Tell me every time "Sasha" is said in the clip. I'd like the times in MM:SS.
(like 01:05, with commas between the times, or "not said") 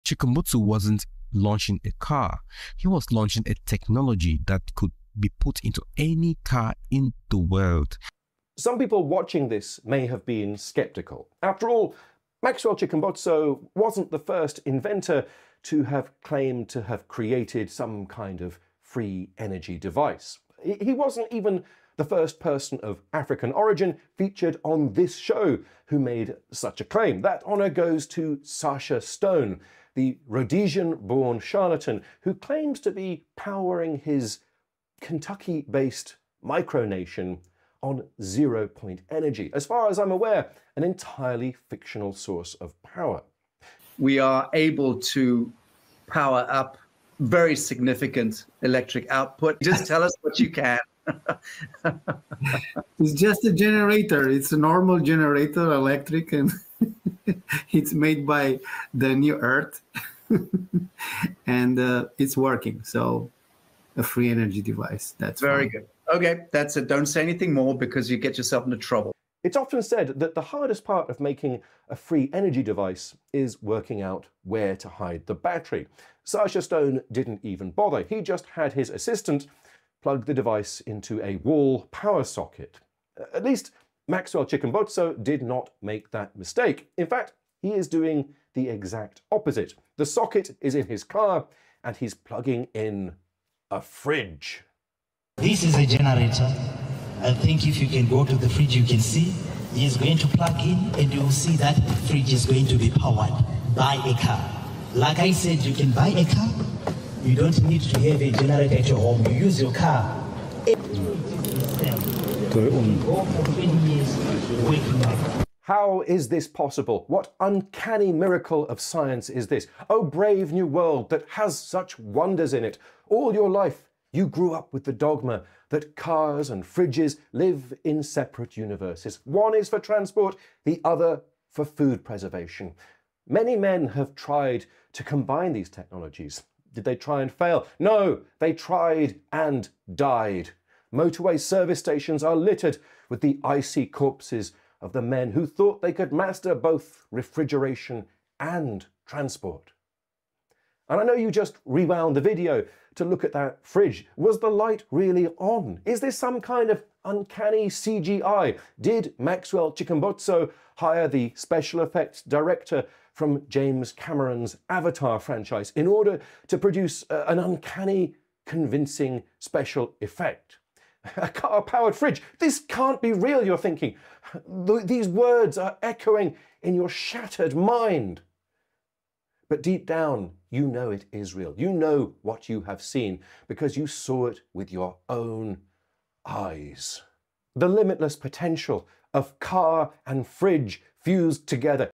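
00:28, 01:16.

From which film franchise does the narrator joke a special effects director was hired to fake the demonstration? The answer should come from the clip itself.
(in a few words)
Avatar.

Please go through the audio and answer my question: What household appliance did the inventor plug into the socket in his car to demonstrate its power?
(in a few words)
A fridge.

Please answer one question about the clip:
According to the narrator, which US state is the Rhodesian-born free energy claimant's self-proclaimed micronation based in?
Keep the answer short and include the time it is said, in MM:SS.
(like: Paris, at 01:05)
Kentucky, at 00:35.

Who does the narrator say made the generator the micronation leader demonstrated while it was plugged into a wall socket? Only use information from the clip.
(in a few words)
The New Earth.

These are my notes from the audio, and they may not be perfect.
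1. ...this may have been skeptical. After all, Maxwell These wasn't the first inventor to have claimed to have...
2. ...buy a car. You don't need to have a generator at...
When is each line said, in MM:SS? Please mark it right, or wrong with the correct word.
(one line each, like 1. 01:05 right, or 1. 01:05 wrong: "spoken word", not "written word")
1. 00:09 wrong: "Chikumbutso", not "These"
2. 01:45 right.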